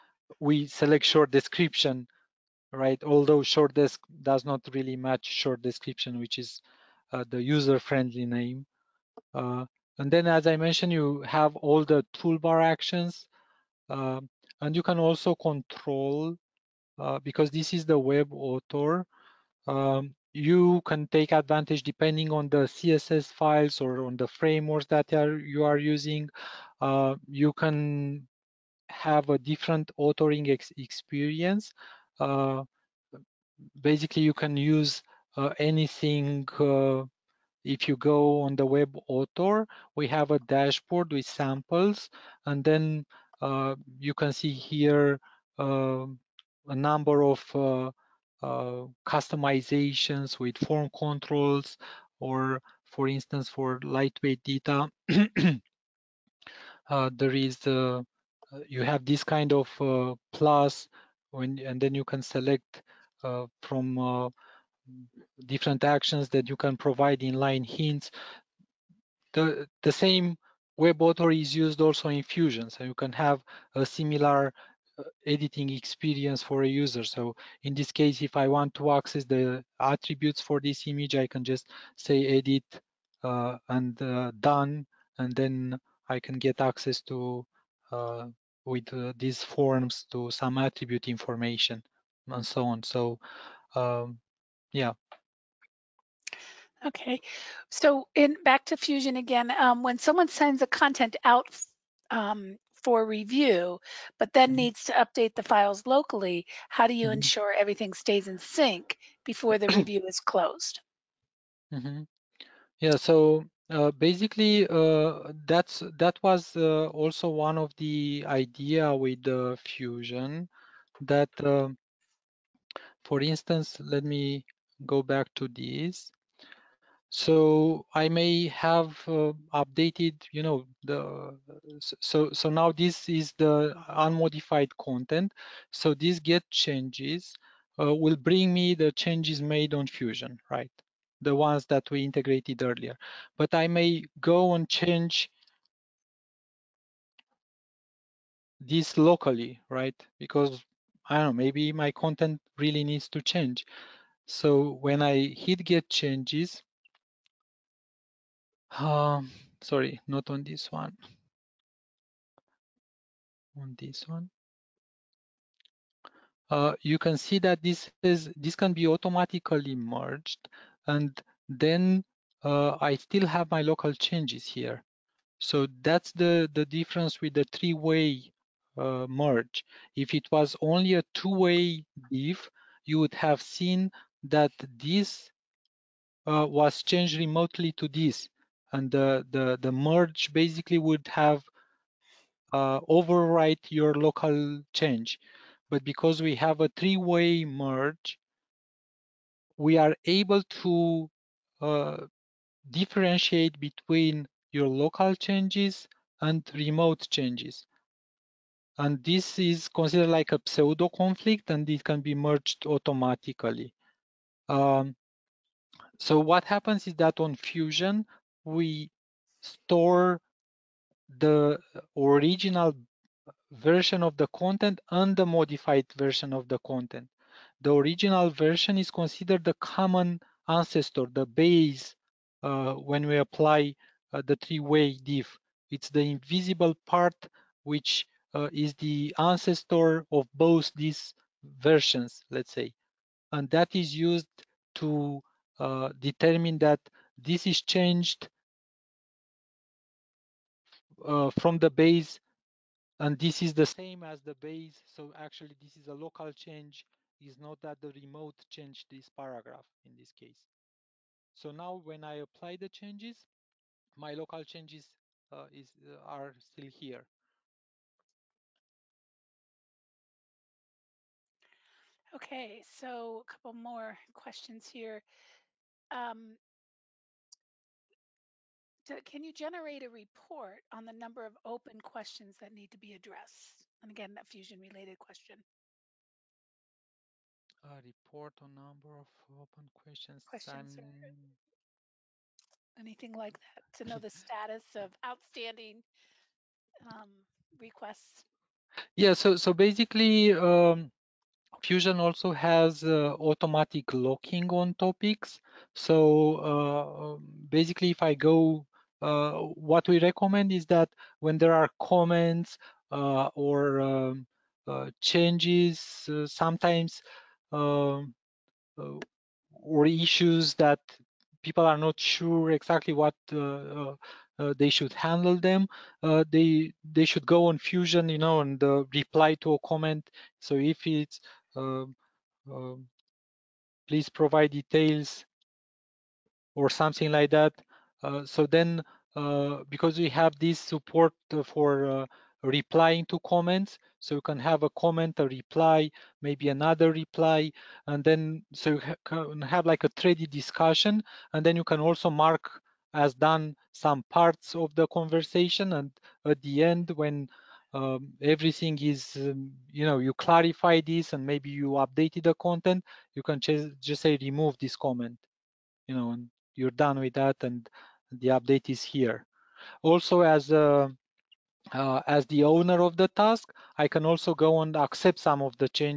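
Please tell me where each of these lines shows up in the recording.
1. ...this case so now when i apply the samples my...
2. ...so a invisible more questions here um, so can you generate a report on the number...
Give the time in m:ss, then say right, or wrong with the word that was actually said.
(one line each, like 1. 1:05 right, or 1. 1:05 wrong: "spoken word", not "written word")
1. 4:19 wrong: "changes", not "samples"
2. 4:32 wrong: "couple", not "invisible".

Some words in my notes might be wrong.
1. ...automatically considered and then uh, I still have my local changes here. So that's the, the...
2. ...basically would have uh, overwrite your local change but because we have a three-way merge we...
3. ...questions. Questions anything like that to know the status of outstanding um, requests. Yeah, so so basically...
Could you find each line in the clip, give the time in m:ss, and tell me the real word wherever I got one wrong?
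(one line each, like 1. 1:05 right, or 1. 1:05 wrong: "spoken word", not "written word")
1. 2:48 wrong: "merged", not "considered"
2. 3:10 right
3. 4:49 right.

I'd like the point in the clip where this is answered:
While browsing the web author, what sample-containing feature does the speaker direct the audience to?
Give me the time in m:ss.
0:40.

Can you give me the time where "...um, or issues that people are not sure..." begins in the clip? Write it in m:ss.
5:17.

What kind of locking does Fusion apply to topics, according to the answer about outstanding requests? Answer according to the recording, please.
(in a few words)
automatic locking.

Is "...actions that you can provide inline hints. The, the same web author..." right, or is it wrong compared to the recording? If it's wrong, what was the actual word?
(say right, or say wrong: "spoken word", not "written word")
right.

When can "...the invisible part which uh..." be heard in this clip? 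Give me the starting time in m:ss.
3:55.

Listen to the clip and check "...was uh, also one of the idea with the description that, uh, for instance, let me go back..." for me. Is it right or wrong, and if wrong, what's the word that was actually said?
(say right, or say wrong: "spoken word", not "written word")
wrong: "fusion", not "description".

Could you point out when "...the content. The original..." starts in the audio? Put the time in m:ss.
3:46.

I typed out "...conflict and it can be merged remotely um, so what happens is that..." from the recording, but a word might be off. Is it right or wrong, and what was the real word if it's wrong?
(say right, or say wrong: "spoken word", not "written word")
wrong: "automatically", not "remotely".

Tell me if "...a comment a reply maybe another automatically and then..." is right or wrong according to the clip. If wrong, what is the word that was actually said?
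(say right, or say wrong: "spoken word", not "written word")
wrong: "reply", not "automatically".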